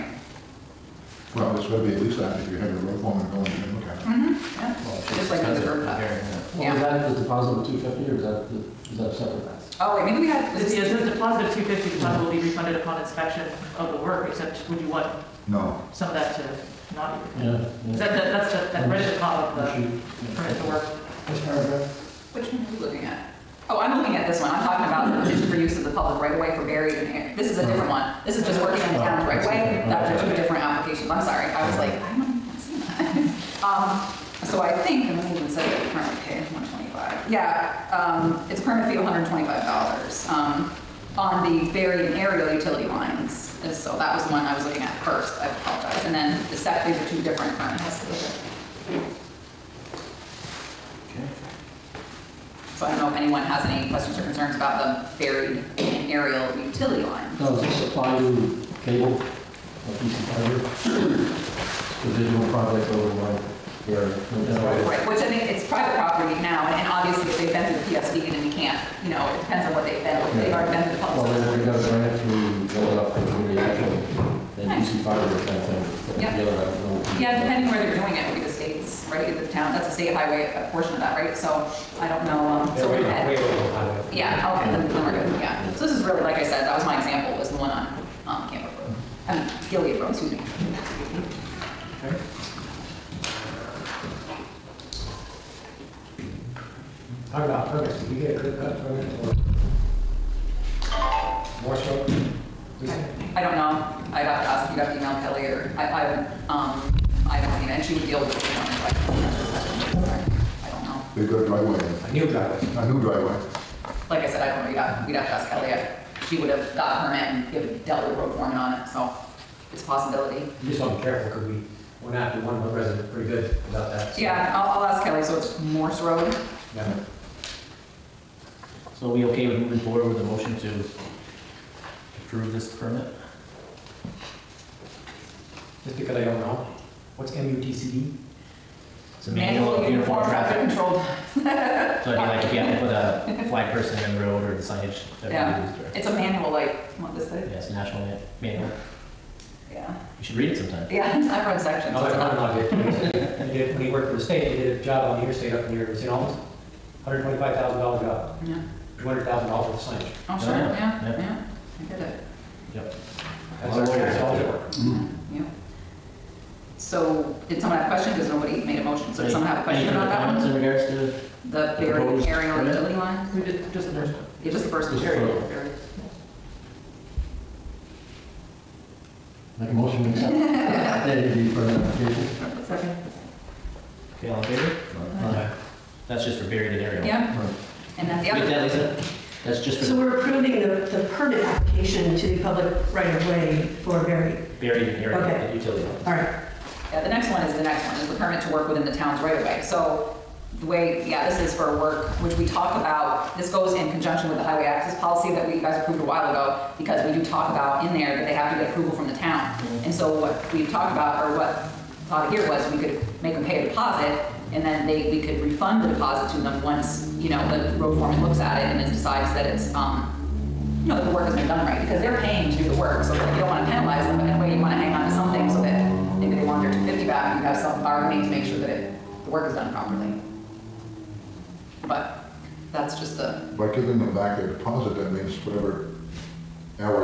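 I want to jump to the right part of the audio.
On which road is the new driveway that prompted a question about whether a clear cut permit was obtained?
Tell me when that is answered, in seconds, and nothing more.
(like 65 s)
125 s.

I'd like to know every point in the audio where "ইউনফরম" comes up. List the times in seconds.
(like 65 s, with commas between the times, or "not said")
not said.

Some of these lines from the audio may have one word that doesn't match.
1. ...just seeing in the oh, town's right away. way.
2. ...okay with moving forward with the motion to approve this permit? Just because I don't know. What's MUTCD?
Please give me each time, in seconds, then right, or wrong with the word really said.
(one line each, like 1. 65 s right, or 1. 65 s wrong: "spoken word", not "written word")
1. 28 s wrong: "working", not "seeing"
2. 129 s right.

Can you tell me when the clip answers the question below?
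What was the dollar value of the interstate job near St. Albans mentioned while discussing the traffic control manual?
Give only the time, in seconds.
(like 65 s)
157 s.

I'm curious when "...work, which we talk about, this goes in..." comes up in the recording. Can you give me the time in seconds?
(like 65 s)
201 s.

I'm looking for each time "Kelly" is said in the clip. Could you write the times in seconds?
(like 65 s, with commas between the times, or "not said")
115 s, 125 s.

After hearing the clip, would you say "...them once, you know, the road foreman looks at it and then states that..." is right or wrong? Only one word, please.
wrong.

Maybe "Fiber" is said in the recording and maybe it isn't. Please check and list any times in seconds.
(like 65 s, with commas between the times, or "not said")
60 s, 75 s.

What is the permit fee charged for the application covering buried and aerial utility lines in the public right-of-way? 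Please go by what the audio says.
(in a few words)
$125.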